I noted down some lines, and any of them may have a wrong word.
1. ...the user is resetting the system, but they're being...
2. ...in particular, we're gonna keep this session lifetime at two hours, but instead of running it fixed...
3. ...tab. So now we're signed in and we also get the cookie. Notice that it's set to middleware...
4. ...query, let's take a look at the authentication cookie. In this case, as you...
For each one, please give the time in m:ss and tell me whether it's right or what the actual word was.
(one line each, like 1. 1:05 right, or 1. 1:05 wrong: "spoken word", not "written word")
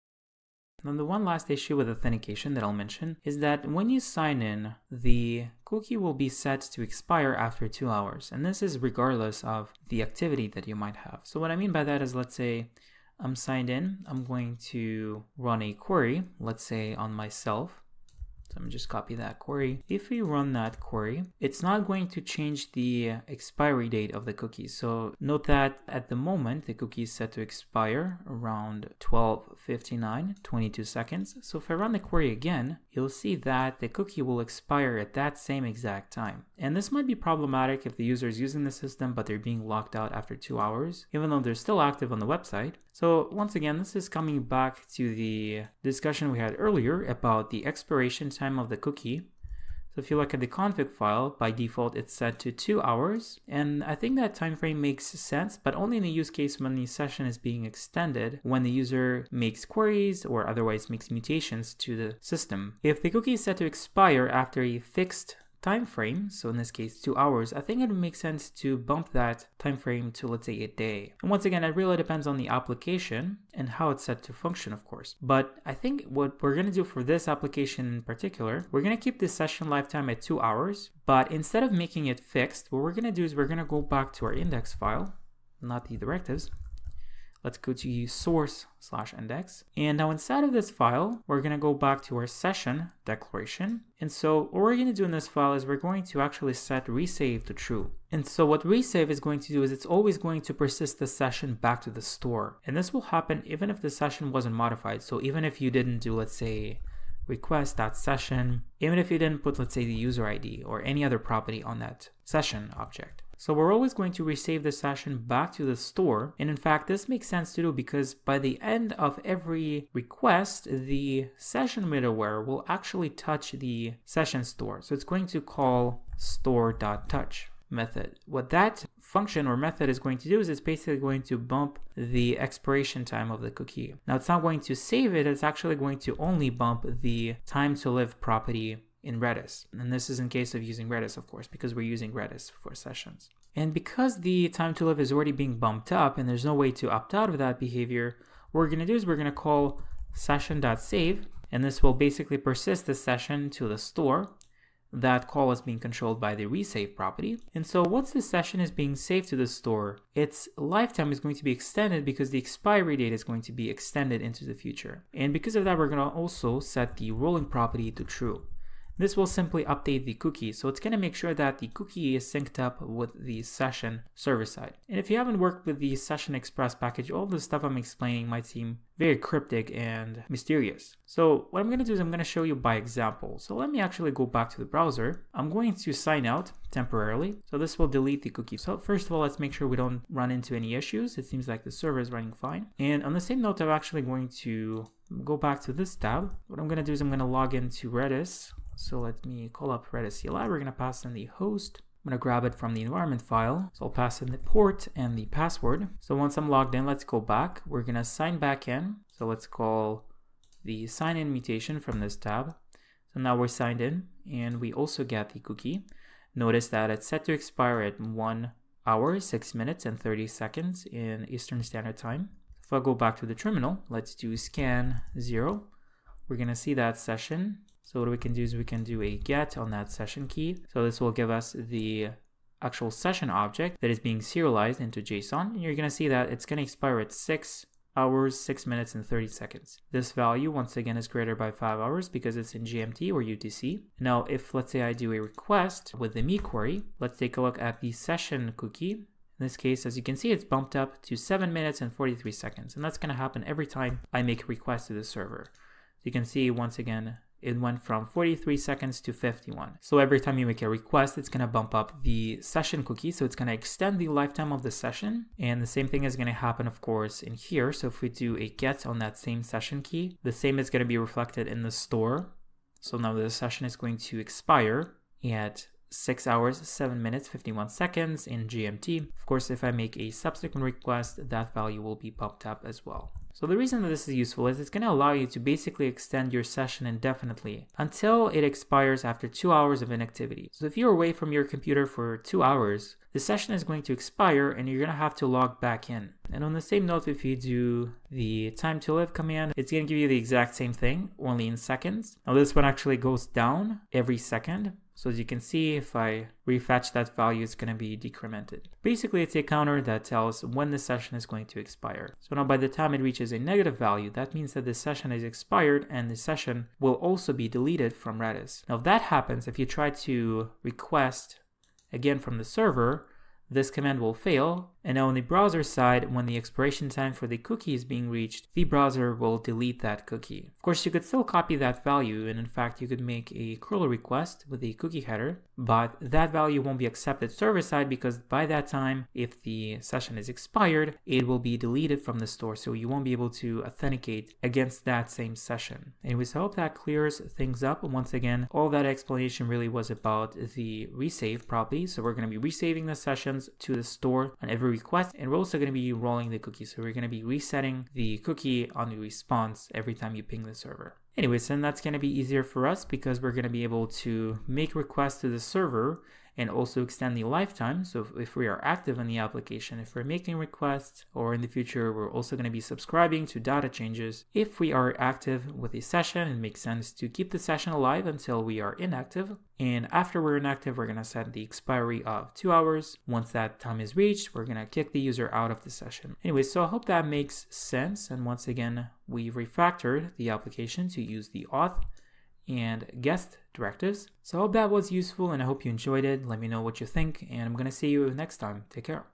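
1. 0:37 wrong: "using", not "resetting"
2. 1:17 wrong: "making", not "running"
3. 3:32 wrong: "expire", not "middleware"
4. 4:06 wrong: "session", not "authentication".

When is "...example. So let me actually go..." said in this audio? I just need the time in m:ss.
3:02.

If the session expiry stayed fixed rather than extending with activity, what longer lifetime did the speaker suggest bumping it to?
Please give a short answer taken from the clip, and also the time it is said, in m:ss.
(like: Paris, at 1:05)
a day, at 1:10.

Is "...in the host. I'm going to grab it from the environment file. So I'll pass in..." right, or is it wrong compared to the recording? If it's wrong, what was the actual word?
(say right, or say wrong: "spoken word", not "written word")
right.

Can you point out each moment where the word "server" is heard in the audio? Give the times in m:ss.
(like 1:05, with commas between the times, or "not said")
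2:54, 3:11, 4:15, 5:22, 5:37, 6:00, 6:05.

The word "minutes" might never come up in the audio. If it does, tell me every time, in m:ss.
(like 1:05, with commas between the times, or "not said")
3:39, 3:58, 4:11, 4:37.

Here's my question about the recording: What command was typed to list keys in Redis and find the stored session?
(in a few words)
scan 0.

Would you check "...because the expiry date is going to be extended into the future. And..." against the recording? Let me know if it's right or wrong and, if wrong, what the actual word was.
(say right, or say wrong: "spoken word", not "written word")
right.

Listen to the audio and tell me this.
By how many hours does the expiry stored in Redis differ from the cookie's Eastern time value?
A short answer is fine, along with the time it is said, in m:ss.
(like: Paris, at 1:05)
5, at 4:01.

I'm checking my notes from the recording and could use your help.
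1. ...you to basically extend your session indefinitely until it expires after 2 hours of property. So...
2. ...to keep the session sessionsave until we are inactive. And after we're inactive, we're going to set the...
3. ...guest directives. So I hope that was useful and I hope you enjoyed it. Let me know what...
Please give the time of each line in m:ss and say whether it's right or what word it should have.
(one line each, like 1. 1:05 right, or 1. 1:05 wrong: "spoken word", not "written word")
1. 4:45 wrong: "inactivity", not "property"
2. 6:16 wrong: "alive", not "sessionsave"
3. 6:33 right.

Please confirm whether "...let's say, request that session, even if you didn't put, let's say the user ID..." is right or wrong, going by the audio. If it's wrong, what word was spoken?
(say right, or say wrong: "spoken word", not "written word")
right.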